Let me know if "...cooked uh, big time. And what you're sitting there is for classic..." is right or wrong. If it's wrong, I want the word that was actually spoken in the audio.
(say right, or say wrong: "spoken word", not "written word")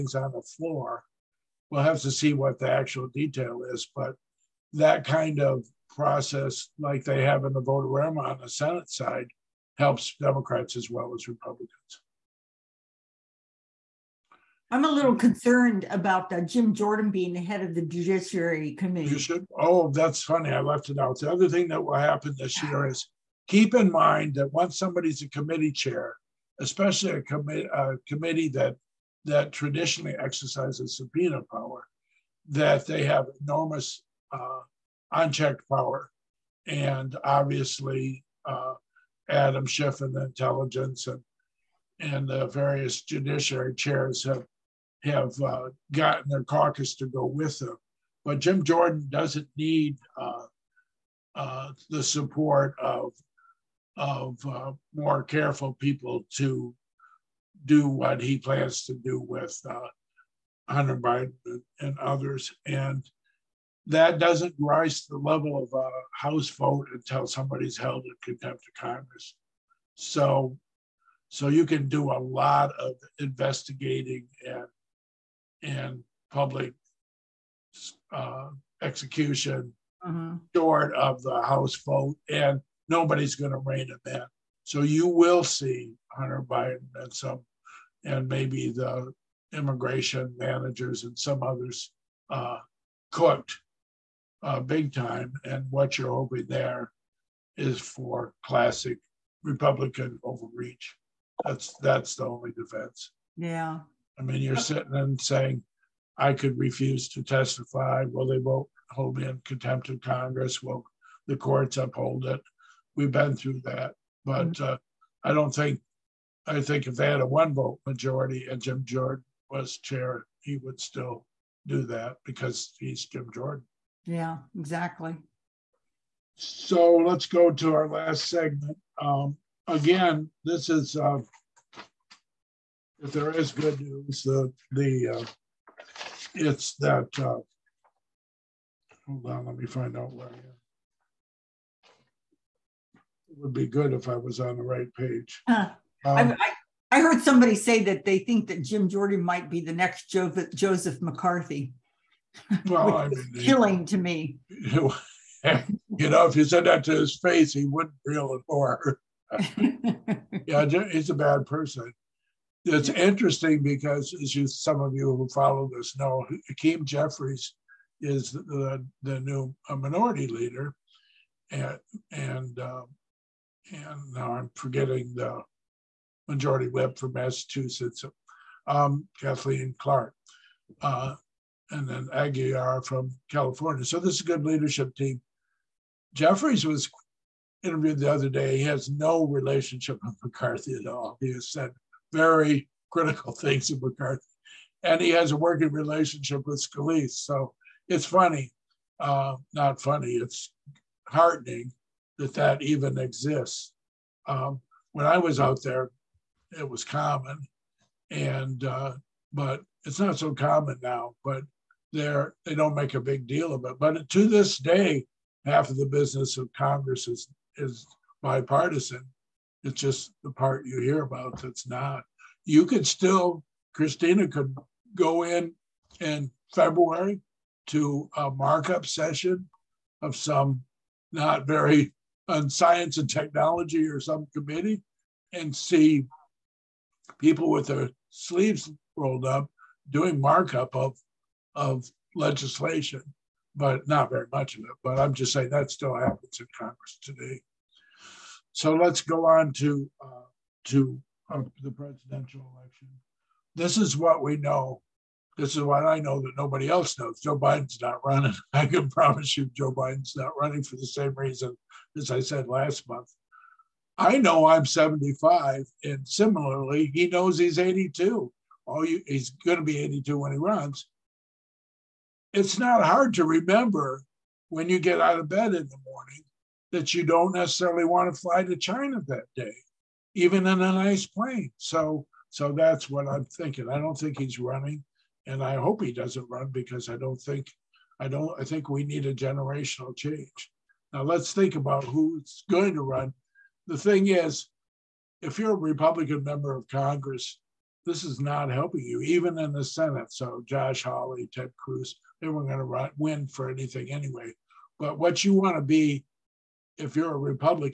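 wrong: "hoping", not "sitting".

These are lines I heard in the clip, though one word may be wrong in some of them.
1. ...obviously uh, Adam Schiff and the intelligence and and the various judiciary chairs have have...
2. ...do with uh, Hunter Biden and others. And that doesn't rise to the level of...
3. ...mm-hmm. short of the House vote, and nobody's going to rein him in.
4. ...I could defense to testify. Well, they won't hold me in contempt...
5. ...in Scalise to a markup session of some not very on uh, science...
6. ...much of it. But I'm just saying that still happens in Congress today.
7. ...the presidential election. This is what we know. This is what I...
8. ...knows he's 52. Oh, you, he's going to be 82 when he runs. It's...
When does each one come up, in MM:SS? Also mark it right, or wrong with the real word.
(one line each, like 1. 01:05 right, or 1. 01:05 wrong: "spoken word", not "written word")
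1. 00:37 right
2. 00:58 right
3. 01:20 right
4. 01:46 wrong: "refuse", not "defense"
5. 03:45 wrong: "February", not "Scalise"
6. 04:04 right
7. 04:11 right
8. 04:27 wrong: "82", not "52".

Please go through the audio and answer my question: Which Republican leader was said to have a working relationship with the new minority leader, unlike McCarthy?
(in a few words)
Scalise.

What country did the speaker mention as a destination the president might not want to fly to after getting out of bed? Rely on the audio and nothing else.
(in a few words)
China.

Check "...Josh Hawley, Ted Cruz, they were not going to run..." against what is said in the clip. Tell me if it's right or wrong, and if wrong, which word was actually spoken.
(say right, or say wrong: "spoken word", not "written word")
right.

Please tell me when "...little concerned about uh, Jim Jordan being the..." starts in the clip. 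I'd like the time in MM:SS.
00:14.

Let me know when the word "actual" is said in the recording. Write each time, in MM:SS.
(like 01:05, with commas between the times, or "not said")
00:02.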